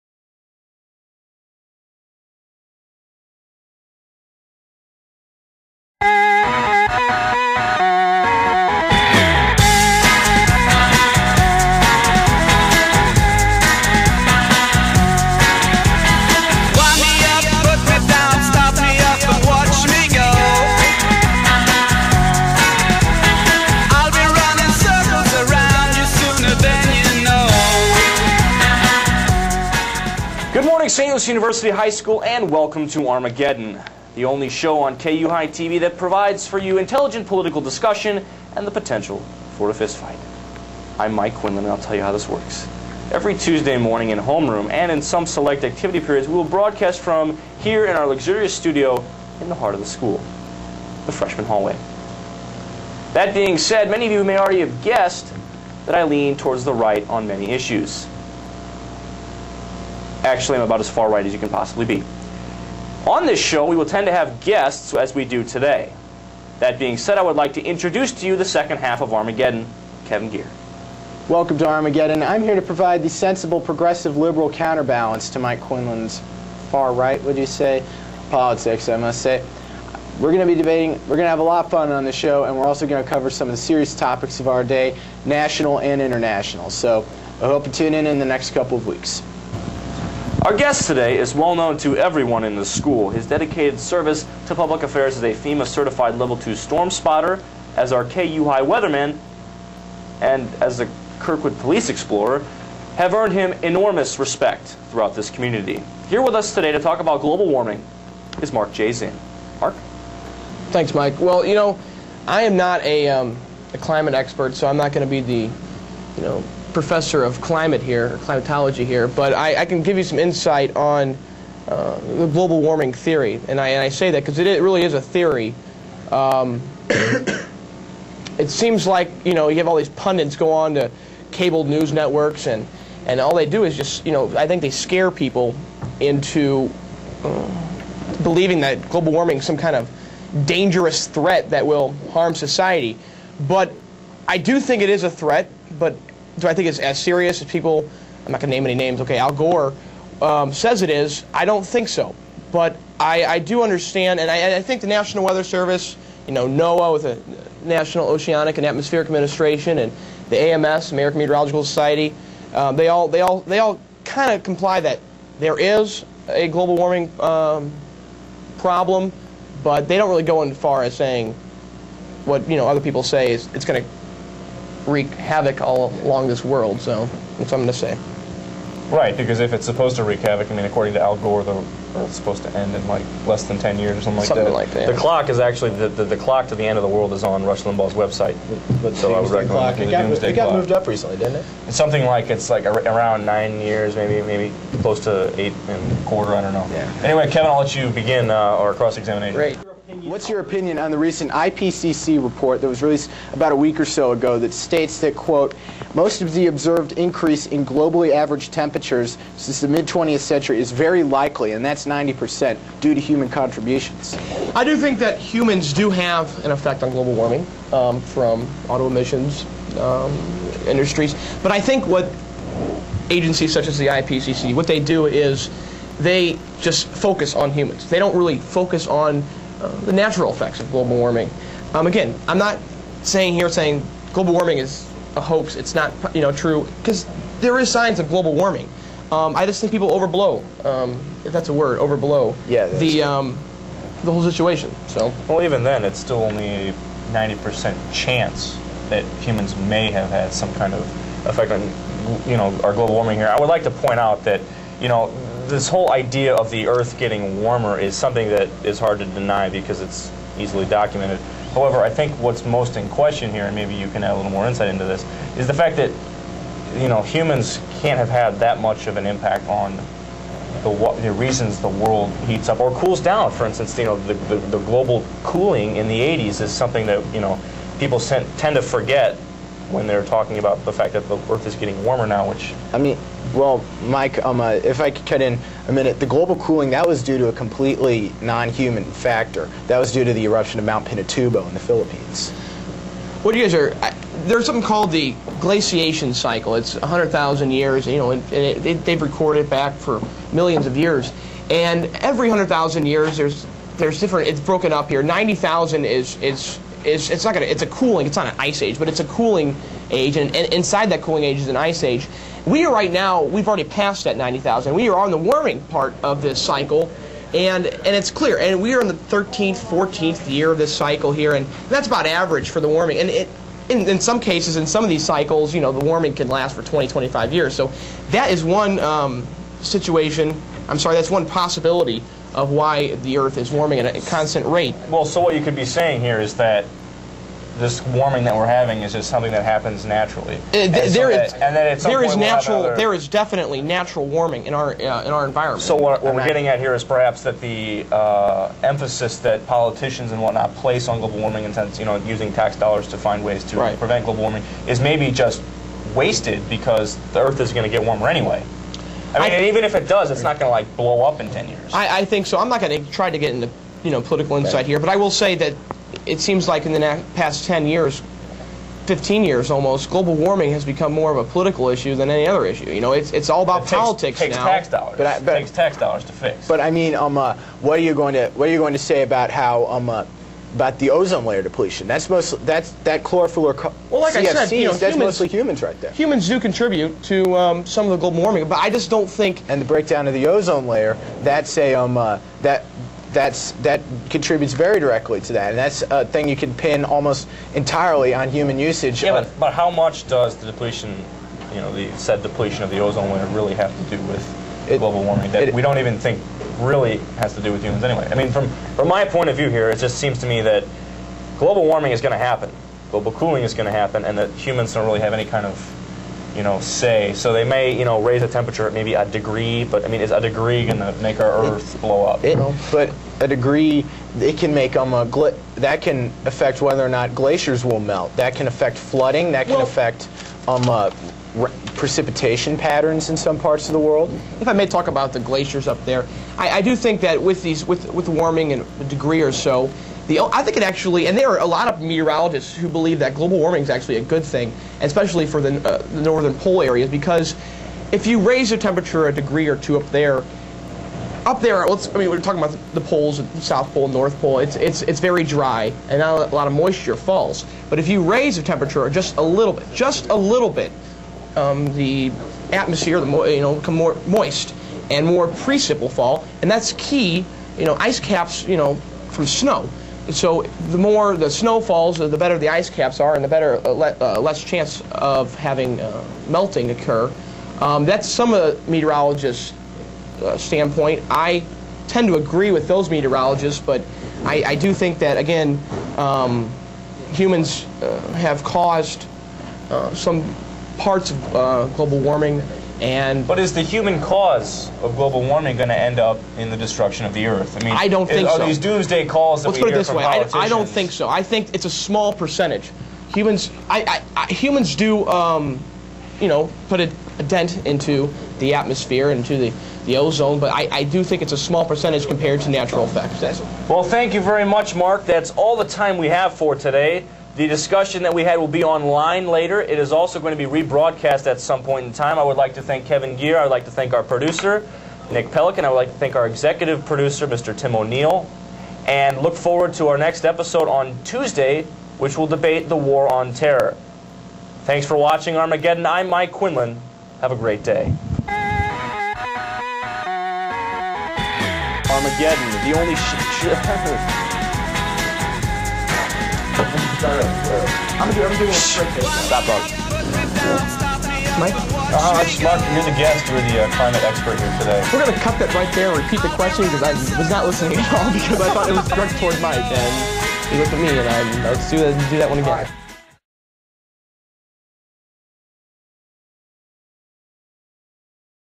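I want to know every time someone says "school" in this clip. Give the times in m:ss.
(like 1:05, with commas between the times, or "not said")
0:31, 0:49, 1:32.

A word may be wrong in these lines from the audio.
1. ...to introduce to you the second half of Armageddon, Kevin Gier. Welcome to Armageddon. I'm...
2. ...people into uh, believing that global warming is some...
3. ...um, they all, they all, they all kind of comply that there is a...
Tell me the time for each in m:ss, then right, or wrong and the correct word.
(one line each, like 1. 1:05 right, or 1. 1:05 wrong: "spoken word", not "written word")
1. 1:07 right
2. 2:15 right
3. 2:42 right.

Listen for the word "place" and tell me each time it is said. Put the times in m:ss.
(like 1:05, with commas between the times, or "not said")
5:50.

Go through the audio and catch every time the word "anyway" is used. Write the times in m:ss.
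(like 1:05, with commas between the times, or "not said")
3:17, 5:58, 6:47.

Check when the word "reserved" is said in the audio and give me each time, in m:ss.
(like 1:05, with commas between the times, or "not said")
not said.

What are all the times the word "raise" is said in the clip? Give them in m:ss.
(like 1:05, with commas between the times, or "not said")
6:58, 7:28, 7:38.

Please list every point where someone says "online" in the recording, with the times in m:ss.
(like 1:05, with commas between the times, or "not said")
8:38.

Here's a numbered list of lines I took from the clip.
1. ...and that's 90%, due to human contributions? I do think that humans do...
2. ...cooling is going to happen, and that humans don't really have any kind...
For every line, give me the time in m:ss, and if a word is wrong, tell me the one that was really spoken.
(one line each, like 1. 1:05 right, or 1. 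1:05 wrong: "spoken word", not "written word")
1. 3:31 right
2. 6:53 right.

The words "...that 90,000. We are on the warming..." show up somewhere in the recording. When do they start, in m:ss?
5:14.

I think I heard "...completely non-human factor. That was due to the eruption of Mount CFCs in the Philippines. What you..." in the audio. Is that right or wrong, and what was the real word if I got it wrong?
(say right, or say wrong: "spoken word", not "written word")
wrong: "Pinatubo", not "CFCs".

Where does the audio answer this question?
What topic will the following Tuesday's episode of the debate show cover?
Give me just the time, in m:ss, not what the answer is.
8:52.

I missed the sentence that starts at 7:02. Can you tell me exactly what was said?
It, but a degree, it can make um, a that can affect whether or not glaciers will melt.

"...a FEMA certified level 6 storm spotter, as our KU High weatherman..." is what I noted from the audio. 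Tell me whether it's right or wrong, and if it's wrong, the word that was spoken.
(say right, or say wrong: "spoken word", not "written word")
wrong: "2", not "6".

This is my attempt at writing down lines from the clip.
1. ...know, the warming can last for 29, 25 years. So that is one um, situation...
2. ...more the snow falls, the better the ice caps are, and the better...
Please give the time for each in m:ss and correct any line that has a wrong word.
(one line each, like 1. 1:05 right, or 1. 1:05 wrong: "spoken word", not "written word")
1. 5:25 wrong: "20", not "29"
2. 7:50 right.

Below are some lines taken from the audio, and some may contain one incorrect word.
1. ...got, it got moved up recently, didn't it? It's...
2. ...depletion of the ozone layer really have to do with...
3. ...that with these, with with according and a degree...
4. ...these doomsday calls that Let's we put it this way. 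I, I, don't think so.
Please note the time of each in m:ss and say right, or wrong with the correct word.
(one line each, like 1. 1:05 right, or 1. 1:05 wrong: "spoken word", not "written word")
1. 3:09 right
2. 6:42 right
3. 7:17 wrong: "warming", not "according"
4. 8:18 right.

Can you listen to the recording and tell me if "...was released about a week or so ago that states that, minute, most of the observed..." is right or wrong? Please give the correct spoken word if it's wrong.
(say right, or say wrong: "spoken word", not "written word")
wrong: "quote", not "minute".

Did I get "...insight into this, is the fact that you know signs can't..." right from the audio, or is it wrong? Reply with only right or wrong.
wrong.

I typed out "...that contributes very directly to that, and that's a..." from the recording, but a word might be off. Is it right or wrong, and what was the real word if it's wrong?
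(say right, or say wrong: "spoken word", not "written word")
right.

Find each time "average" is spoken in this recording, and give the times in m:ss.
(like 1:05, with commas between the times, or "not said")
3:28, 5:22.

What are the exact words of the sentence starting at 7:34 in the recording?
It's, it's, it's very dry, and not a lot of moisture falls.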